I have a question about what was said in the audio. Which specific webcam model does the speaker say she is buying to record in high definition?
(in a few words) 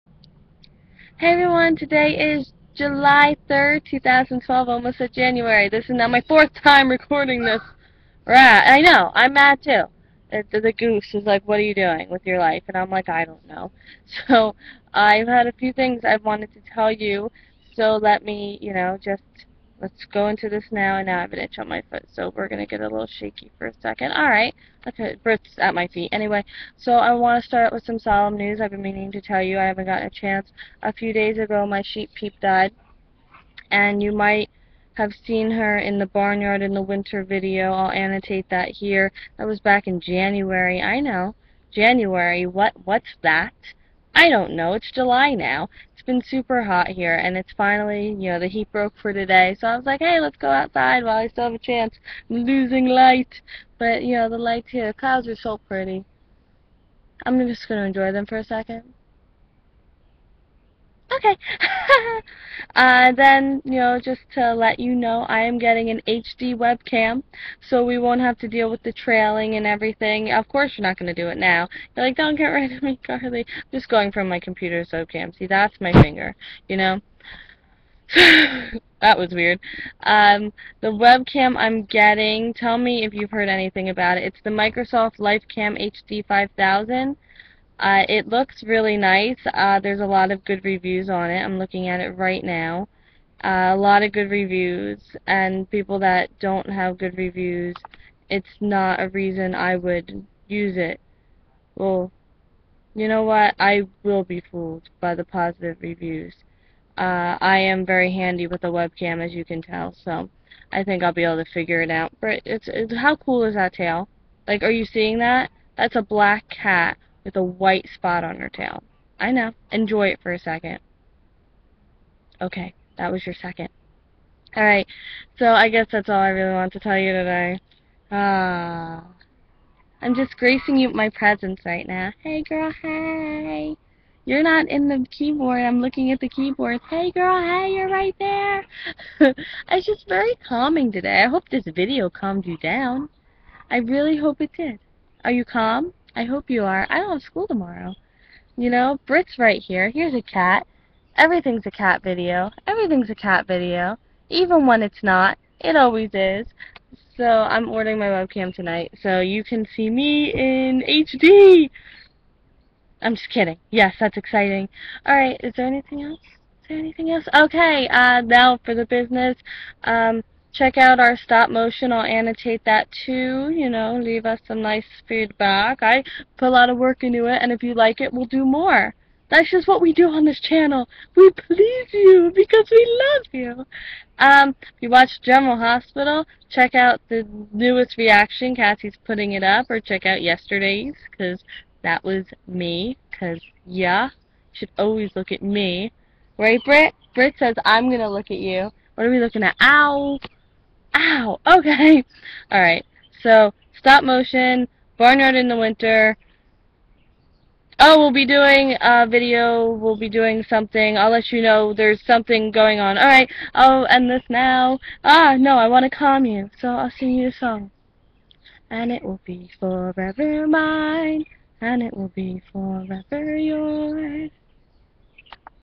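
Microsoft LifeCam HD 5000.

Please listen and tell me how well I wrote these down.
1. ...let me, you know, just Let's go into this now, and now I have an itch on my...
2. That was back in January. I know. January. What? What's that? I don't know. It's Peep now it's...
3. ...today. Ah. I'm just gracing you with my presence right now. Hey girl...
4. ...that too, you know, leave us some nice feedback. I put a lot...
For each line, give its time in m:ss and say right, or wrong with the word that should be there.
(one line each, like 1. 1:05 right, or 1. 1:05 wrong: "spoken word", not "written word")
1. 0:18 right
2. 0:39 wrong: "July", not "Peep"
3. 2:07 right
4. 2:52 right.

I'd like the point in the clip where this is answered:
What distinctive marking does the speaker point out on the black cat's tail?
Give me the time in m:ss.
1:57.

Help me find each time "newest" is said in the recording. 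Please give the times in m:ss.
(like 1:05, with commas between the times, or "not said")
3:07.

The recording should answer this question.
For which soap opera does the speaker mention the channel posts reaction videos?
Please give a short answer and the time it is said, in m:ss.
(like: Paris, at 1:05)
General Hospital, at 3:05.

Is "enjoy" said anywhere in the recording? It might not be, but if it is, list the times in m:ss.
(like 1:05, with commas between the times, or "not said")
0:57, 1:59.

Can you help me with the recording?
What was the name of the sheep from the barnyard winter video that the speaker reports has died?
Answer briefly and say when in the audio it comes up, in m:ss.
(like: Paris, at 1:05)
Peep, at 0:32.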